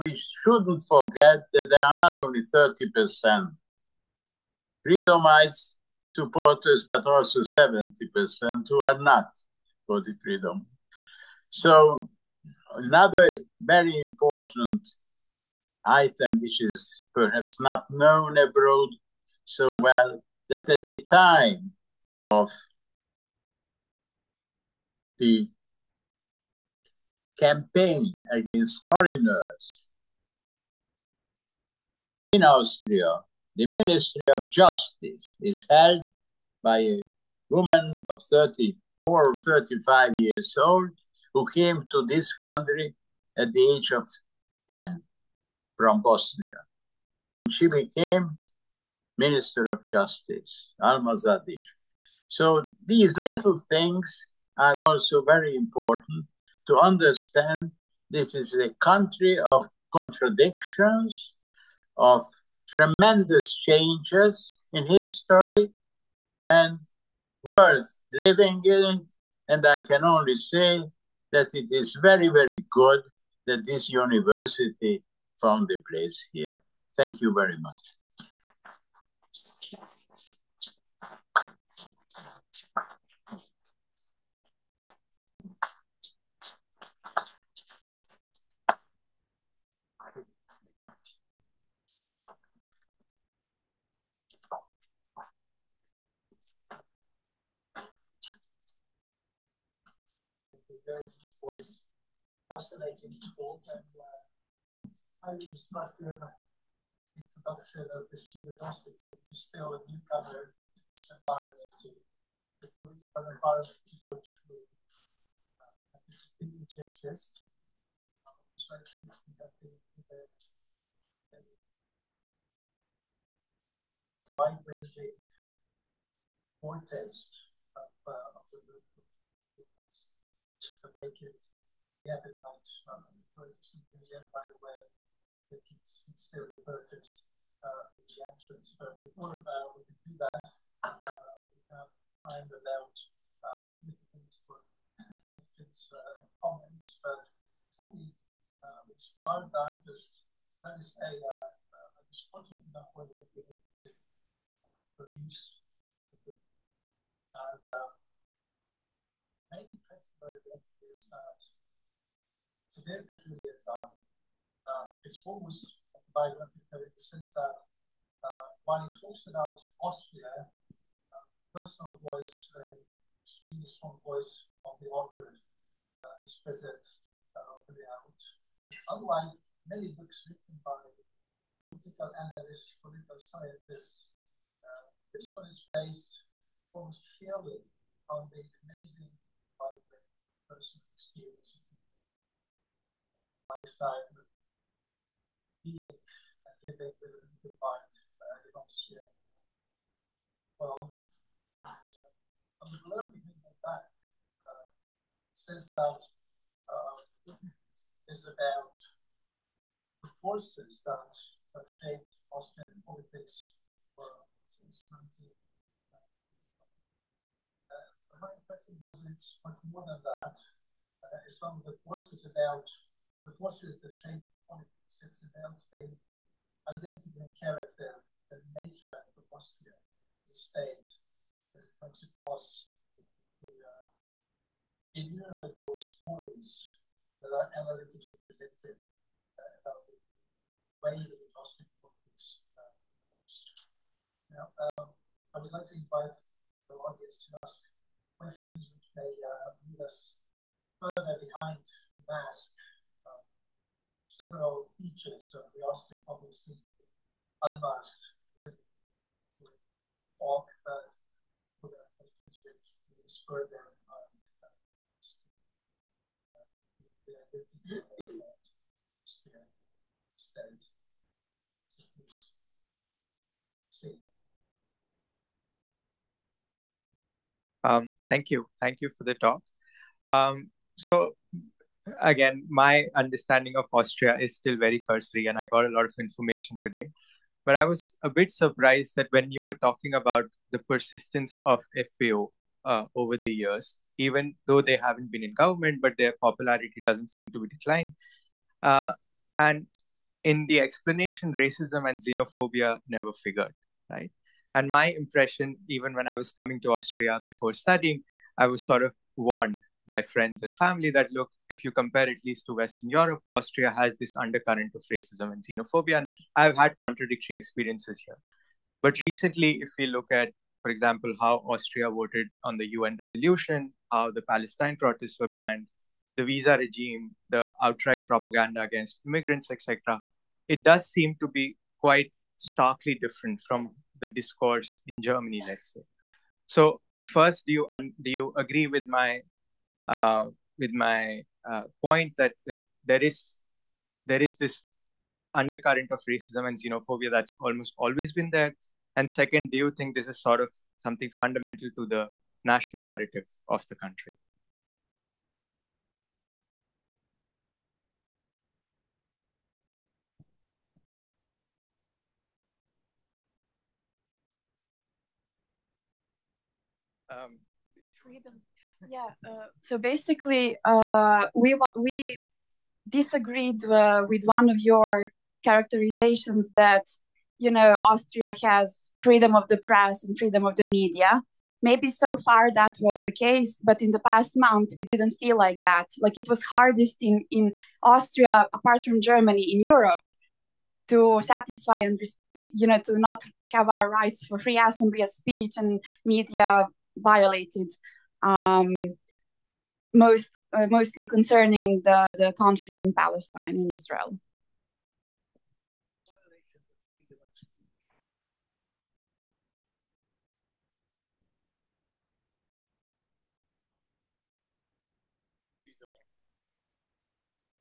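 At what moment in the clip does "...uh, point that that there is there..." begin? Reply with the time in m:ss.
5:41.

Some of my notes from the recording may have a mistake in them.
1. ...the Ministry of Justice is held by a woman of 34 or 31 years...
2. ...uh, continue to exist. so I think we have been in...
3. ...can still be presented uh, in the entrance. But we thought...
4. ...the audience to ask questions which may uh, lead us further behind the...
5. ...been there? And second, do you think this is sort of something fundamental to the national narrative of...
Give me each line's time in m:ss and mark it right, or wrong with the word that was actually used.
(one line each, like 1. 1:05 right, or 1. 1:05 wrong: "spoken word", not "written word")
1. 0:33 wrong: "35", not "31"
2. 1:55 right
3. 2:15 wrong: "purchased", not "presented"
4. 4:06 right
5. 5:48 right.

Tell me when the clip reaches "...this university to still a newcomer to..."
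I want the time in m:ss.
1:48.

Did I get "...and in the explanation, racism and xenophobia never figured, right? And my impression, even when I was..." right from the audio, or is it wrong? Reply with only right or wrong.
right.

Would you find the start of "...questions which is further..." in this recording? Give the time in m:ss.
4:21.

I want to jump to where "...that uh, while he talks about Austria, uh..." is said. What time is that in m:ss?
2:47.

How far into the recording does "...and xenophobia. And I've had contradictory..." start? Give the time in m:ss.
5:15.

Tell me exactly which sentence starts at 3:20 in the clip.
Well, and, uh, I'm learning thinking back.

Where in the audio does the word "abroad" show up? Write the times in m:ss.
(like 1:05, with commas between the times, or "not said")
0:18.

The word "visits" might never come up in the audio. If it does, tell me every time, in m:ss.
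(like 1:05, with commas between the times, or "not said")
3:38.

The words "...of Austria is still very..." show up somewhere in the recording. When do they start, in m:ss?
4:43.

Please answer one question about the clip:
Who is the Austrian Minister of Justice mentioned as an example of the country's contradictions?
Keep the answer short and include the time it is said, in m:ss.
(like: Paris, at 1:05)
Alma Zadic, at 0:50.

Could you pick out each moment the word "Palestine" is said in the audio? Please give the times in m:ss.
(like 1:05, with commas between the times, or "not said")
5:24, 6:42.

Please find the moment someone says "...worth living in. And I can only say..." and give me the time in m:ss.
1:07.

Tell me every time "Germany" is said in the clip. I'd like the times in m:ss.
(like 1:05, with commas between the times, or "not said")
5:35, 6:28.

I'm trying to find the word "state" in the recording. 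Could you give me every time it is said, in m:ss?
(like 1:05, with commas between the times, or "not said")
3:50, 4:29.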